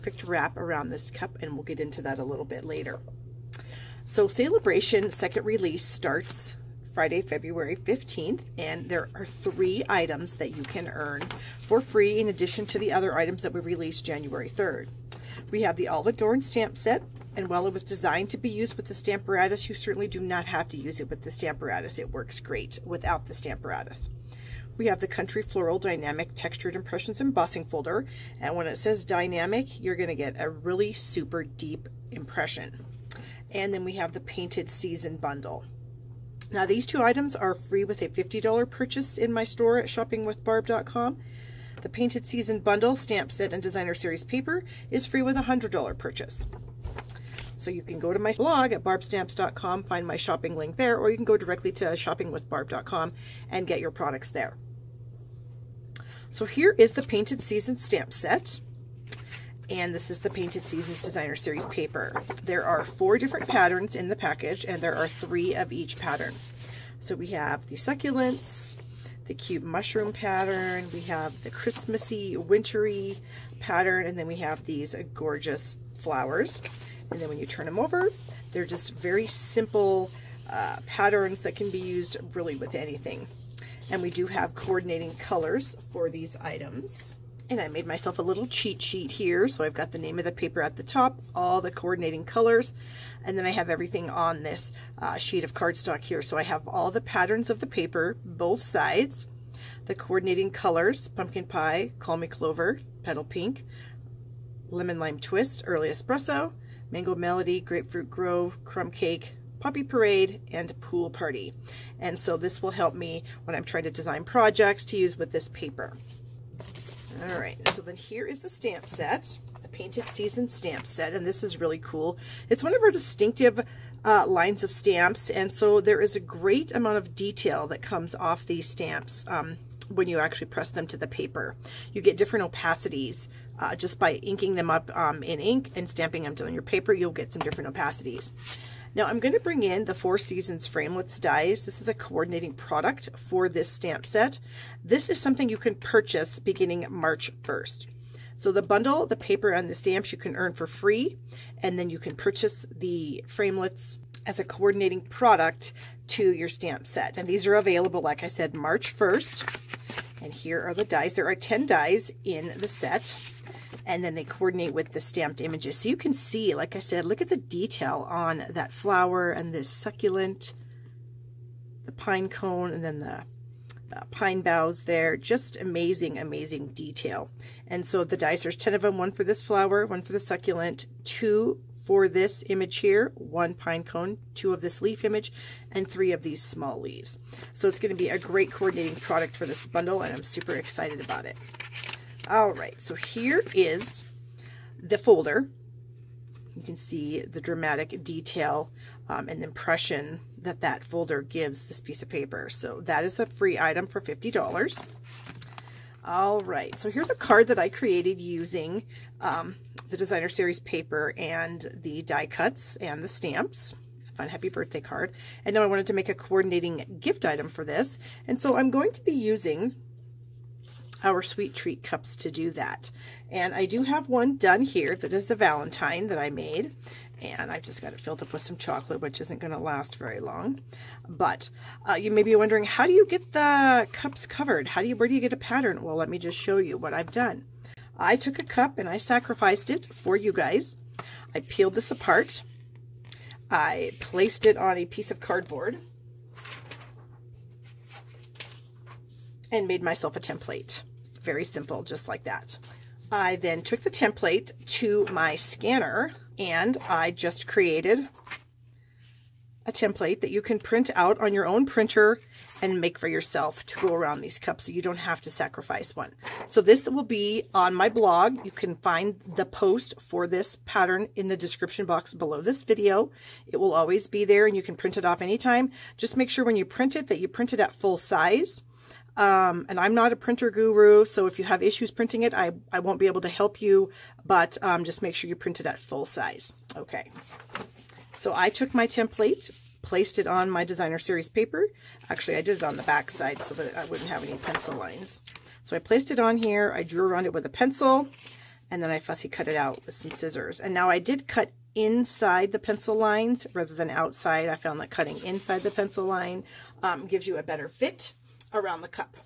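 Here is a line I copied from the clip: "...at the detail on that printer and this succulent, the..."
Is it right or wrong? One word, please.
wrong.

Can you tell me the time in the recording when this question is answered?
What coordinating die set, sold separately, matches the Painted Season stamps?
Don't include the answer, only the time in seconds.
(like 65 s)
139 s.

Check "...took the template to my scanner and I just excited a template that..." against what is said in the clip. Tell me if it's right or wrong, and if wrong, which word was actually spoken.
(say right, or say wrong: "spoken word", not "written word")
wrong: "created", not "excited".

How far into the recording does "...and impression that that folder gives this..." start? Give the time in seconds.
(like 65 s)
199 s.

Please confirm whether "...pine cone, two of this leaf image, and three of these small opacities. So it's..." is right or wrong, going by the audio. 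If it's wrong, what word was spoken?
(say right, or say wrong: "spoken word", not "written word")
wrong: "leaves", not "opacities".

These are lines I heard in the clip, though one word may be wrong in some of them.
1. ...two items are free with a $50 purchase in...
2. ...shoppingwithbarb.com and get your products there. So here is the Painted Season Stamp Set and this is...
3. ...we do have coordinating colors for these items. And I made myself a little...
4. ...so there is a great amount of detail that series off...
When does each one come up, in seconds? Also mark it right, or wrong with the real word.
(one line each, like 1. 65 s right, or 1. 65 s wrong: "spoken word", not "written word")
1. 36 s right
2. 51 s right
3. 84 s right
4. 125 s wrong: "comes", not "series".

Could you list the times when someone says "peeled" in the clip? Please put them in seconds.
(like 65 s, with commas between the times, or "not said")
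241 s.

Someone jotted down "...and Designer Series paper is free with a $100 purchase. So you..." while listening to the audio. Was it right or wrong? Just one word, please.
right.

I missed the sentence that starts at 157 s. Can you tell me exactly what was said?
And these are available, like I said, March 1st.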